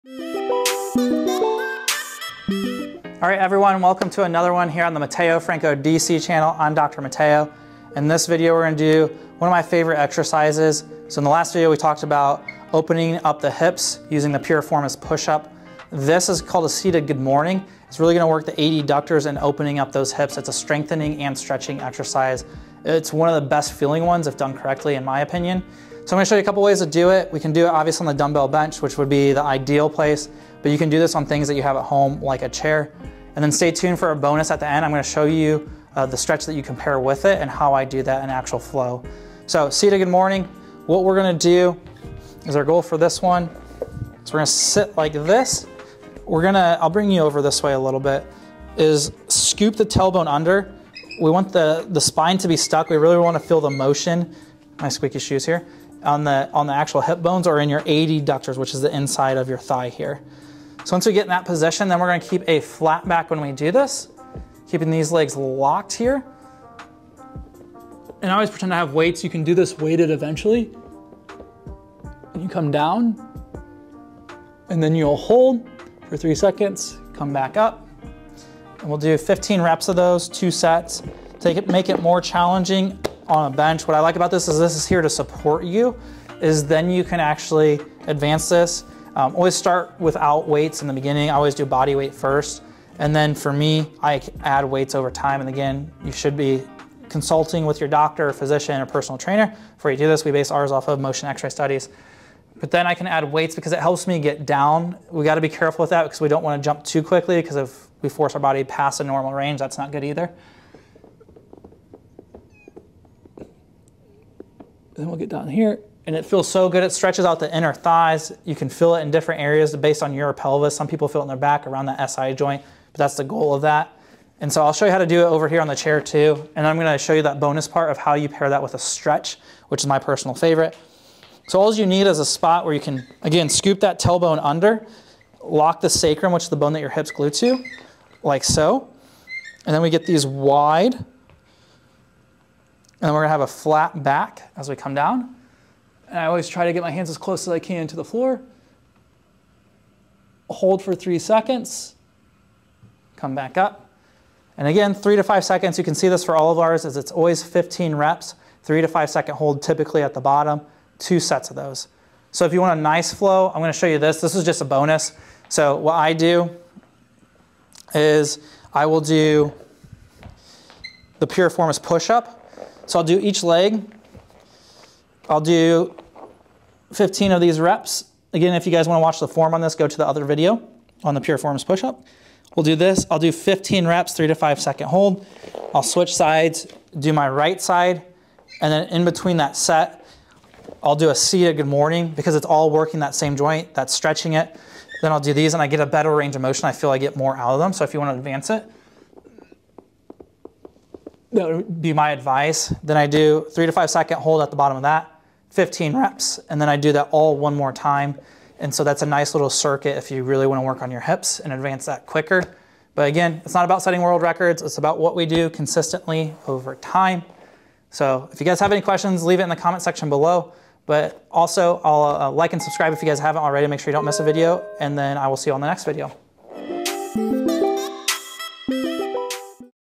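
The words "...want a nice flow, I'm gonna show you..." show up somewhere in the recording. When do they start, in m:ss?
2:42.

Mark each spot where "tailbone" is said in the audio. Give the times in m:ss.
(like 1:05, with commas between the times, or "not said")
0:49, 2:13.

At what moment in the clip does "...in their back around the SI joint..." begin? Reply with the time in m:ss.
2:01.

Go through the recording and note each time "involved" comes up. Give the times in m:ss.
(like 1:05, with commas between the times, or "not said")
not said.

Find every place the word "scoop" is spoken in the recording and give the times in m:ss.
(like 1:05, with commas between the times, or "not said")
0:49, 2:13.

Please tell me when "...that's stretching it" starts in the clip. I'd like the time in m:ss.
3:13.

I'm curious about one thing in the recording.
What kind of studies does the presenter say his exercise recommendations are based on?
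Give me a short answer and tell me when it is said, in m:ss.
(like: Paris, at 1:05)
motion x-ray studies, at 1:40.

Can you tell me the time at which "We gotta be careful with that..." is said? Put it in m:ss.
1:45.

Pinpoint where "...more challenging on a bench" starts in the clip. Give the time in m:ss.
1:22.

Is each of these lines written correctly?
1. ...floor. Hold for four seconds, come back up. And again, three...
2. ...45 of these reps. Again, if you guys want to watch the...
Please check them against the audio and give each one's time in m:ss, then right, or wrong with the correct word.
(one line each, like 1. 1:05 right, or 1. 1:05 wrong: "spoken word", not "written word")
1. 2:28 wrong: "three", not "four"
2. 2:56 wrong: "15", not "45".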